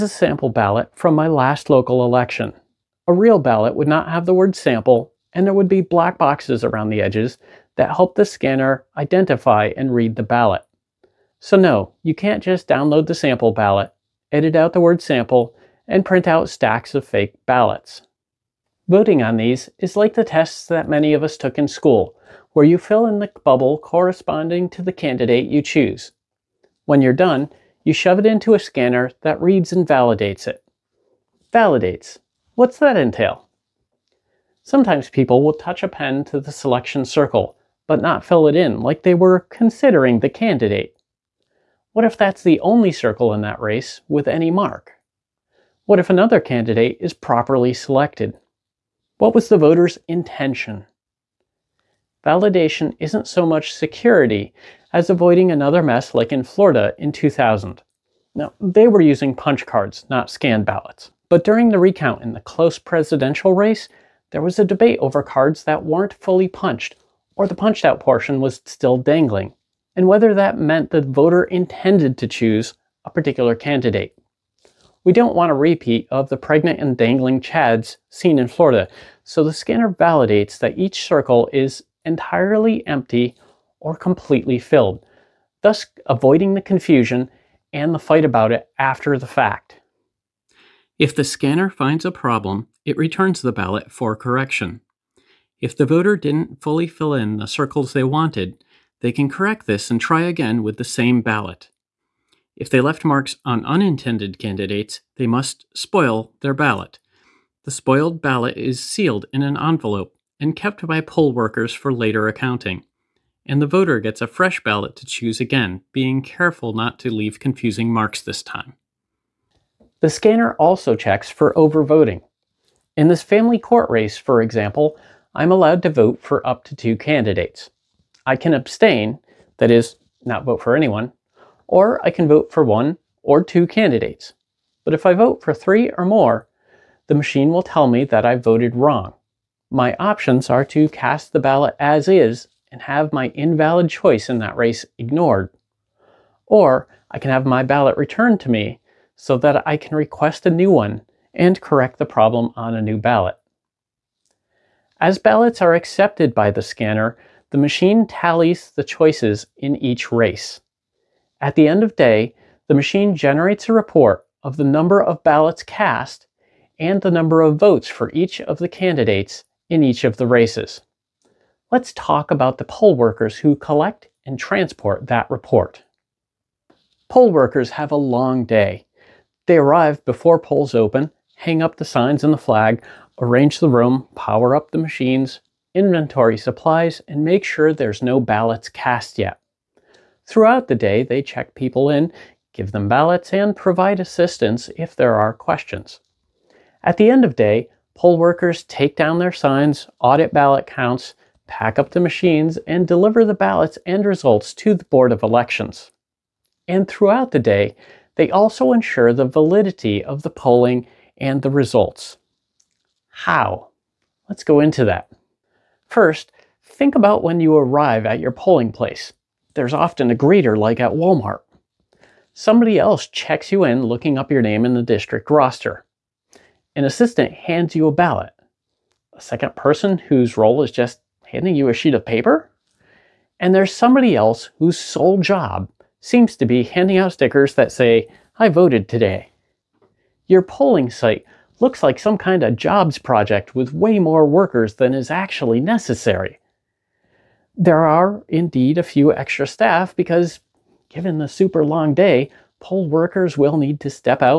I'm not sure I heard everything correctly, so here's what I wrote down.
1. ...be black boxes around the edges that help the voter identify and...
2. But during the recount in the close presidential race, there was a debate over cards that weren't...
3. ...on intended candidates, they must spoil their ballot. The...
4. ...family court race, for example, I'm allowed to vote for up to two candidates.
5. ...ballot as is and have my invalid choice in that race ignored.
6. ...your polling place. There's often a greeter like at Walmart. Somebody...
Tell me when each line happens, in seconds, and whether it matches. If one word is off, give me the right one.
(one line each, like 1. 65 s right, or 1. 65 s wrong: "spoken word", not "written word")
1. 5 s wrong: "scanner", not "voter"
2. 61 s right
3. 103 s wrong: "unintended", not "intended"
4. 123 s right
5. 141 s right
6. 218 s right.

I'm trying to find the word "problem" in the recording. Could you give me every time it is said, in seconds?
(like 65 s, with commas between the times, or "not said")
92 s, 152 s.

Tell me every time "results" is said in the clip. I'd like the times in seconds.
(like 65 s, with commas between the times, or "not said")
204 s, 211 s.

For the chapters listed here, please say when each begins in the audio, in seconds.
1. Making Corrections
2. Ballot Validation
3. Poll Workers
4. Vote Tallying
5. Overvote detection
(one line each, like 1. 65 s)
1. 89 s
2. 30 s
3. 176 s
4. 153 s
5. 119 s.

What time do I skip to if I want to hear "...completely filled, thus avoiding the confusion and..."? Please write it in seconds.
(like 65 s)
83 s.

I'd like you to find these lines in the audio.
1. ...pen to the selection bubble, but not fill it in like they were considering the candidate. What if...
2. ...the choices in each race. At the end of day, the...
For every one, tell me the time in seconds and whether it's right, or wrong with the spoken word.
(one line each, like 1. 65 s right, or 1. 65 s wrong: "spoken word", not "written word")
1. 35 s wrong: "circle", not "bubble"
2. 158 s right.